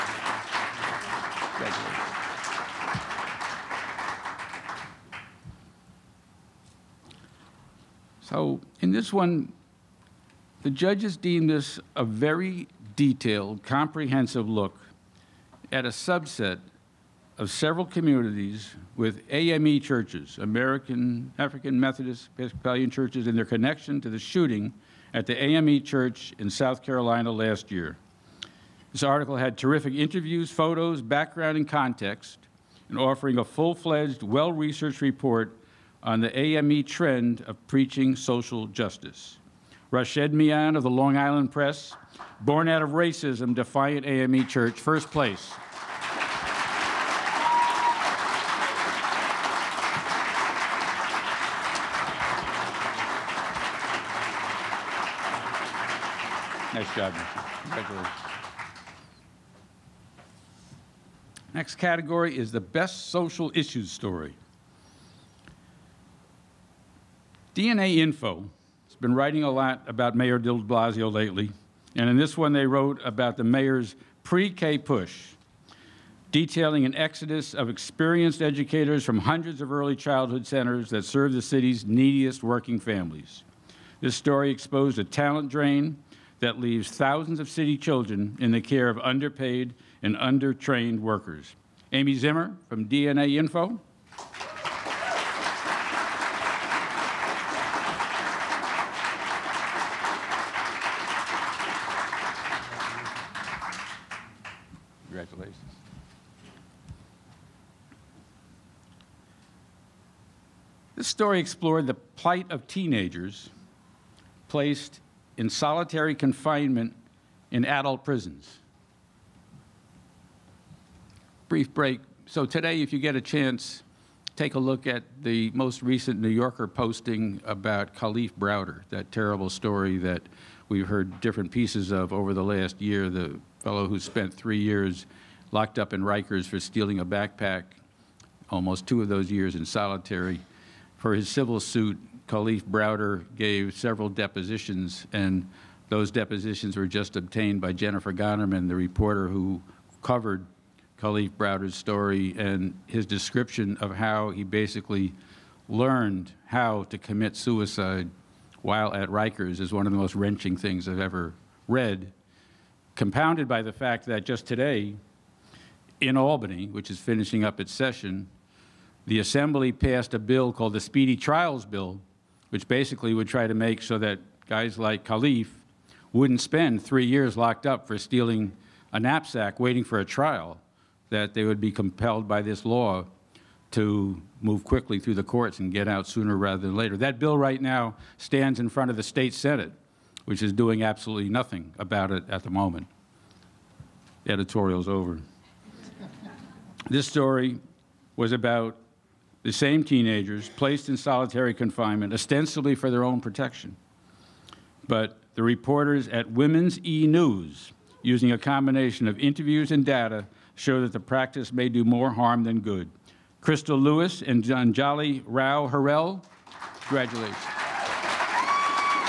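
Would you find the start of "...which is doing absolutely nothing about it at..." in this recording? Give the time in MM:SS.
03:10.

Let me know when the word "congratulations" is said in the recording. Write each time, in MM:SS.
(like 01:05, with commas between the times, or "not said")
00:57, 03:36.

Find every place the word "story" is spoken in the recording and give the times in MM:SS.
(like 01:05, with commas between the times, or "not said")
01:03, 01:24, 01:51, 02:09, 02:31, 03:17.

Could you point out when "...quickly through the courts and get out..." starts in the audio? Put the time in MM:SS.
03:04.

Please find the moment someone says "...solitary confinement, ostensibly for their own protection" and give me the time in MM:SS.
03:20.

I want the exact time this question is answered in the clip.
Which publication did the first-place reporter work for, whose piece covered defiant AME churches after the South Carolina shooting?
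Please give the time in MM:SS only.
00:40.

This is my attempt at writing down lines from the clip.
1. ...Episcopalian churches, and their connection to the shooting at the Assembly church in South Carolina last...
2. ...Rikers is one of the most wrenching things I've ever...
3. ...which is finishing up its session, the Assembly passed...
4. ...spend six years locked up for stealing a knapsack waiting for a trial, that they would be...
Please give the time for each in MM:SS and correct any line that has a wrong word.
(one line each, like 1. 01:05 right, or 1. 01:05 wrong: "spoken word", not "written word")
1. 00:22 wrong: "AME", not "Assembly"
2. 02:39 right
3. 02:46 right
4. 02:56 wrong: "three", not "six".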